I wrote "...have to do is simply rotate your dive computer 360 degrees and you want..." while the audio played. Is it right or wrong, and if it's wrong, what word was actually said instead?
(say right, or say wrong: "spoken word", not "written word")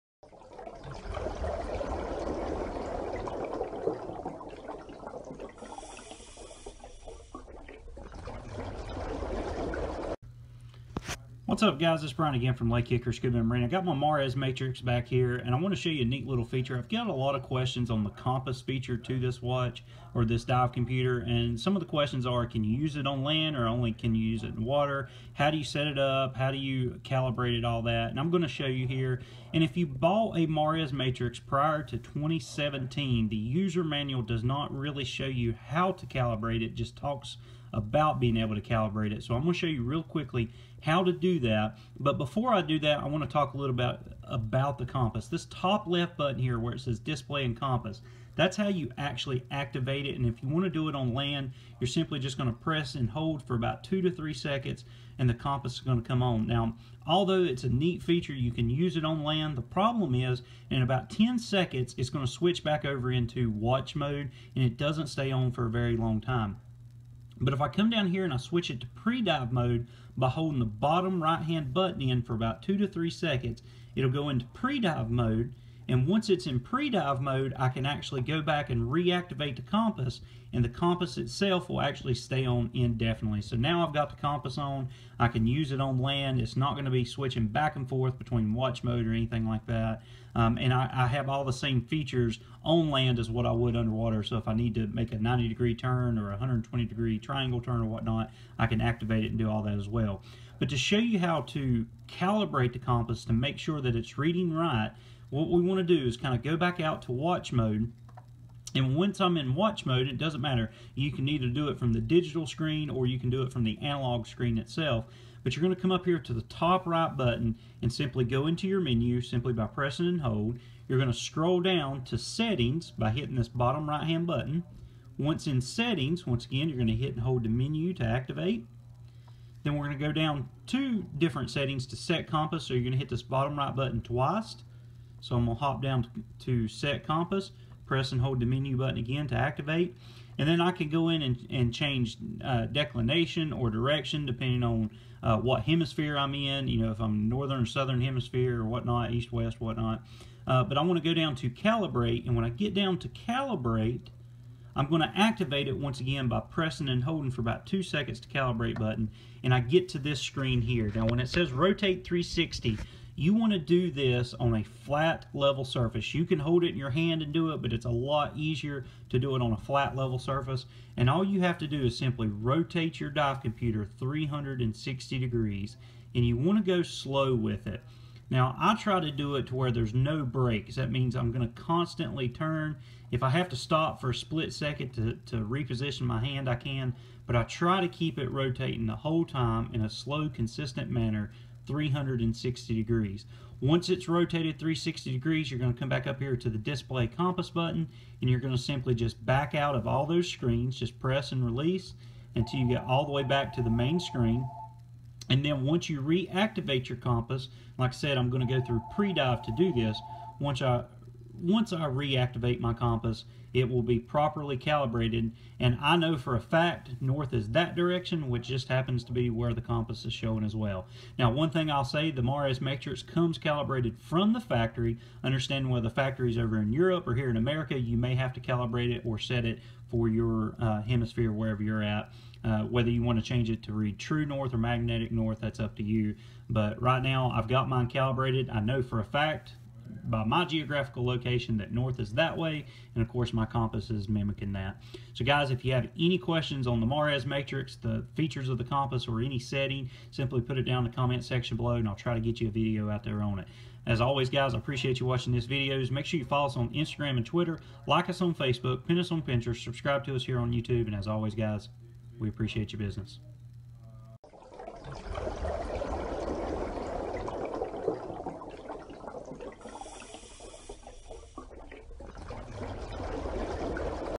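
right.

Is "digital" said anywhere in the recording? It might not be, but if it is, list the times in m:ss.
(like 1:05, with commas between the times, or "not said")
1:51.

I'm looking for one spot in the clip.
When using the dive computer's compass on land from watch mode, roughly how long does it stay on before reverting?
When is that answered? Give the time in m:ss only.
1:01.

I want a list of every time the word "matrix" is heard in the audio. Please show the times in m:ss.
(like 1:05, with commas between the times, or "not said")
0:14, 0:30, 3:42, 4:07.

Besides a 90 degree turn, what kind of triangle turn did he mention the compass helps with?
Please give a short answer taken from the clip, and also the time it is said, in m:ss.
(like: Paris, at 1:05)
120 degree, at 1:36.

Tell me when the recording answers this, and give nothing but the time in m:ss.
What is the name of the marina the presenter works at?
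0:12.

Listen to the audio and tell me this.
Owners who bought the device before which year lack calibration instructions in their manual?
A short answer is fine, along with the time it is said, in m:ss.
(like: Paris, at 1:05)
2017, at 0:31.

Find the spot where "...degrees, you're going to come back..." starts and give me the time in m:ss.
3:15.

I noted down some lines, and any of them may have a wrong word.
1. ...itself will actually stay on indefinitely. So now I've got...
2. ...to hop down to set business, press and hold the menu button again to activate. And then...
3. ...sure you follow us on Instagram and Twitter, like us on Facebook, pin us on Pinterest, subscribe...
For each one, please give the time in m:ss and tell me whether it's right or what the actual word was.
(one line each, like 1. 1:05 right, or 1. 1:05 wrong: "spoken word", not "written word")
1. 1:21 right
2. 2:15 wrong: "compass", not "business"
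3. 4:16 right.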